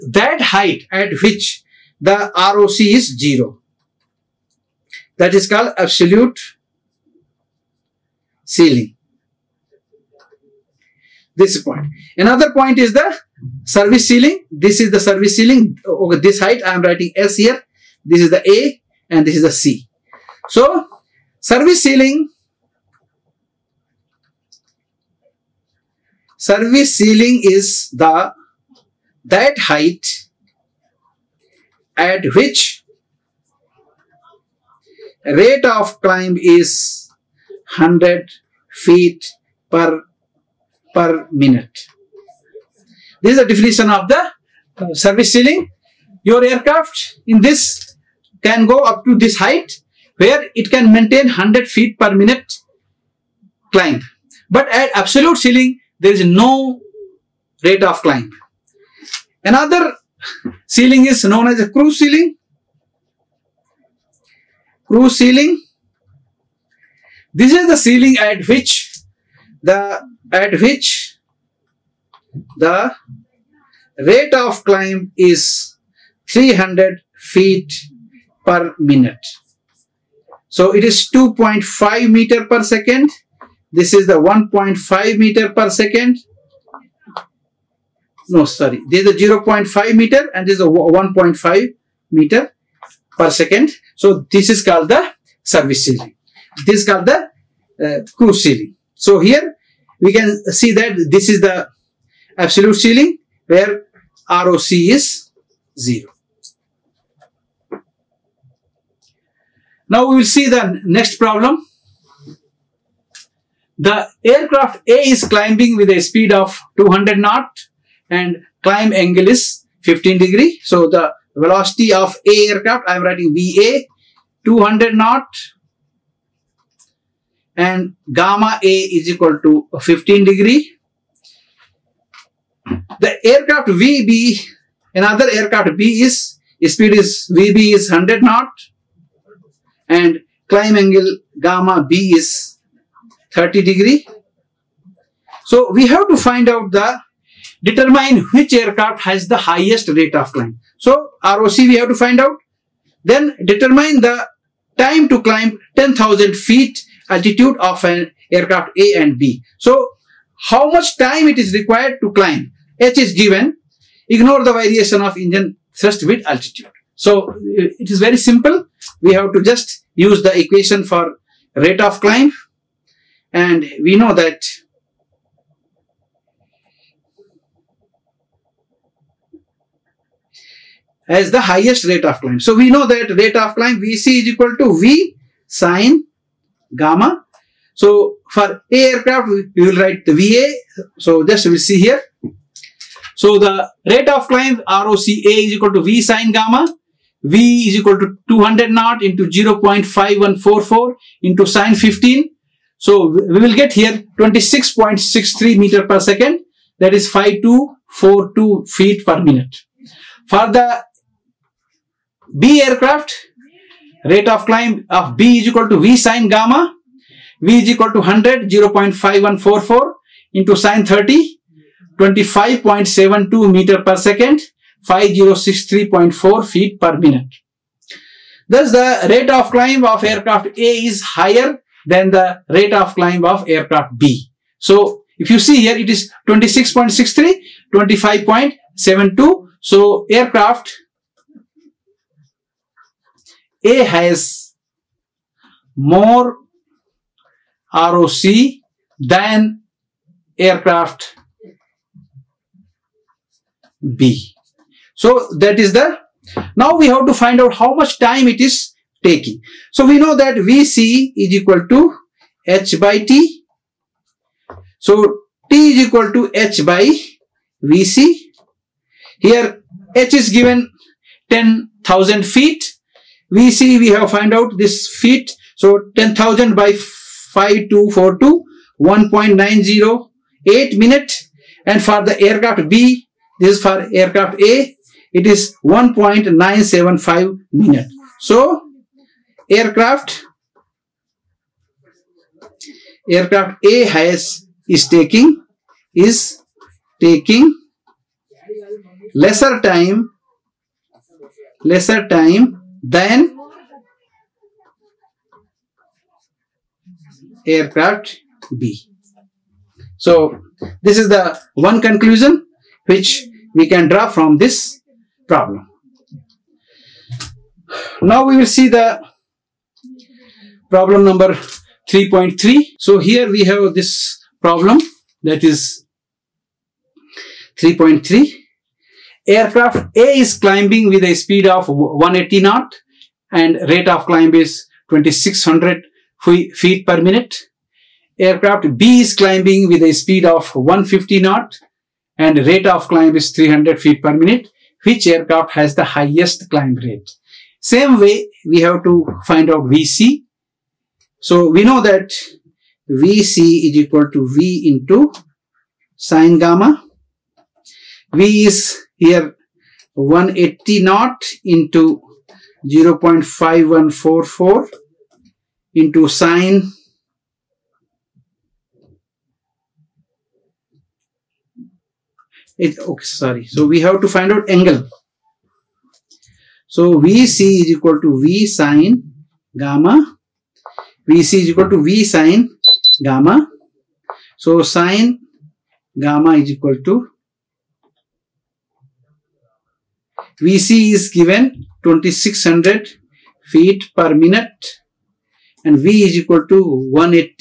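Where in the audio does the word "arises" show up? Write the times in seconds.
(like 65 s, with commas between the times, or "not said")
not said.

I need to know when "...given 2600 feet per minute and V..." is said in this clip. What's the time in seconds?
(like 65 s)
391 s.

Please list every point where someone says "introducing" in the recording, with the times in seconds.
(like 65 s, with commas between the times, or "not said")
not said.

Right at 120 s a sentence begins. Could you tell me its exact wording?
So the velocity of A aircraft, I am writing VA 200 knot and gamma A is equal to 15 degree.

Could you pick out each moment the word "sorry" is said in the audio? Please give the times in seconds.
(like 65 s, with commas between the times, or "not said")
88 s, 373 s.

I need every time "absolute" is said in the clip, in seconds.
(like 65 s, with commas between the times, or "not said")
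5 s, 54 s, 102 s.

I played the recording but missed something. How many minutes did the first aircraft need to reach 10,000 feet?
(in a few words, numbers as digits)
1.908 minutes.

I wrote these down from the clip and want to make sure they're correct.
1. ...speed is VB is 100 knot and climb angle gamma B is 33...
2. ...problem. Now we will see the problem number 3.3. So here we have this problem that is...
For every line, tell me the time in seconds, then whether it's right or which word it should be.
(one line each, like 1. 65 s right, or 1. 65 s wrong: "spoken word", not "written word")
1. 136 s wrong: "30", not "33"
2. 315 s right.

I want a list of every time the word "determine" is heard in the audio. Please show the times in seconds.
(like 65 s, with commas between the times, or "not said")
147 s, 153 s.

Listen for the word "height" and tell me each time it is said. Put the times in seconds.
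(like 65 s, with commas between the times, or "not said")
0 s, 16 s, 29 s, 49 s.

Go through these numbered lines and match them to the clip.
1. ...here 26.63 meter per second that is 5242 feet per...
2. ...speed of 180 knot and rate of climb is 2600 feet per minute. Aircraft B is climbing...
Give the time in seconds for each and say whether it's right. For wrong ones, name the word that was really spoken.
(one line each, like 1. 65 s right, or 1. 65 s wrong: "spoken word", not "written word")
1. 203 s right
2. 331 s right.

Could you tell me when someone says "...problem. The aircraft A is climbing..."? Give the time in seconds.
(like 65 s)
111 s.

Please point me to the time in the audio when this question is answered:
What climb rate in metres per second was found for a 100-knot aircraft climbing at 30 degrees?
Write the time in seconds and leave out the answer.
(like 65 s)
221 s.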